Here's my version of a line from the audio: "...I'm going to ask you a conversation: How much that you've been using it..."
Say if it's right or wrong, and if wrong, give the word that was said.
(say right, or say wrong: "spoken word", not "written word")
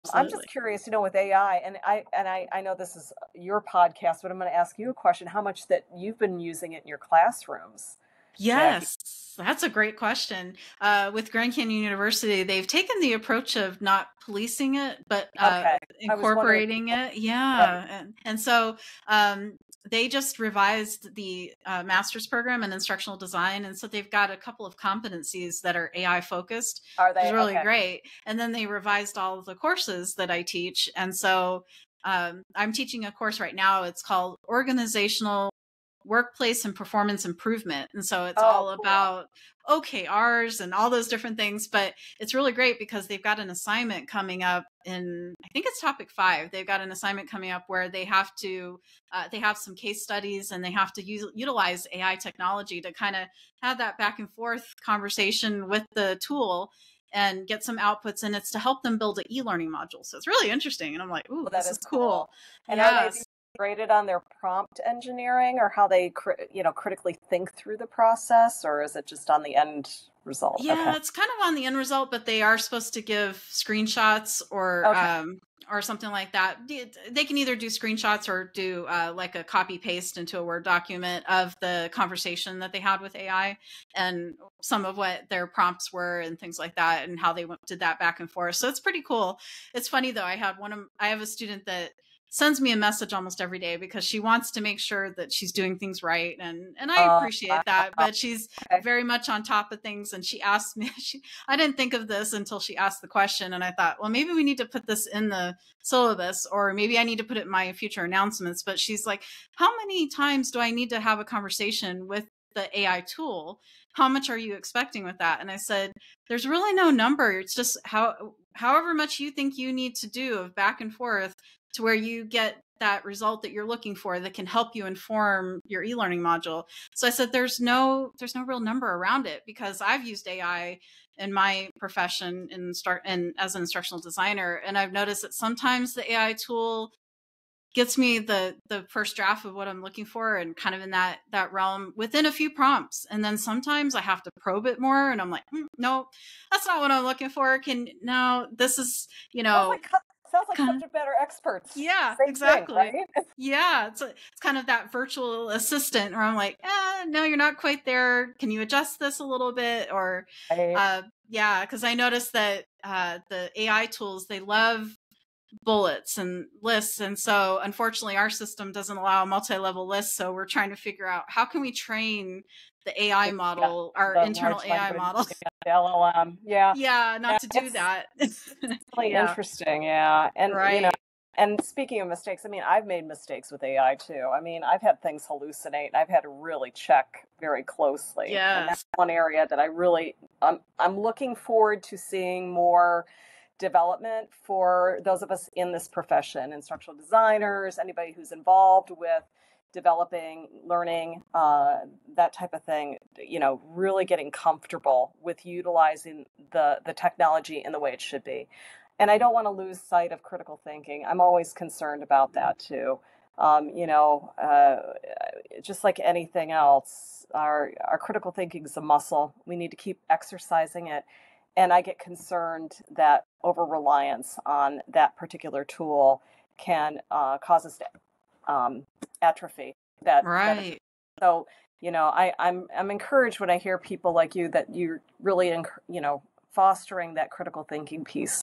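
wrong: "question", not "conversation".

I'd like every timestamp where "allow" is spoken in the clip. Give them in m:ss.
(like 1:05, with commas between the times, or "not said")
2:48.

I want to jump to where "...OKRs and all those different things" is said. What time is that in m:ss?
0:39.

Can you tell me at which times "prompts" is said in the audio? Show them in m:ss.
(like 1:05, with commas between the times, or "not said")
1:04, 1:25, 2:22.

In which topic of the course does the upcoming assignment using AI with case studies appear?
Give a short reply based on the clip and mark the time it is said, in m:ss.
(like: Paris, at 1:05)
Topic 5, at 0:45.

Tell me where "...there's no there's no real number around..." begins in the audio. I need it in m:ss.
2:07.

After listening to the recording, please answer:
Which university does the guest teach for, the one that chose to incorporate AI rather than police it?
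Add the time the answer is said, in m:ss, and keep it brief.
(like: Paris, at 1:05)
Grand Canyon University, at 0:11.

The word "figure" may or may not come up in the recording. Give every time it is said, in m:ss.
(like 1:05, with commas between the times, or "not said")
2:50.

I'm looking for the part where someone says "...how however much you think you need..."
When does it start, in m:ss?
1:57.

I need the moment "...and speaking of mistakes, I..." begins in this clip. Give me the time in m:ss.
3:01.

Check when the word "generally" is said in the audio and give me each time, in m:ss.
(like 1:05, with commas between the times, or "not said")
not said.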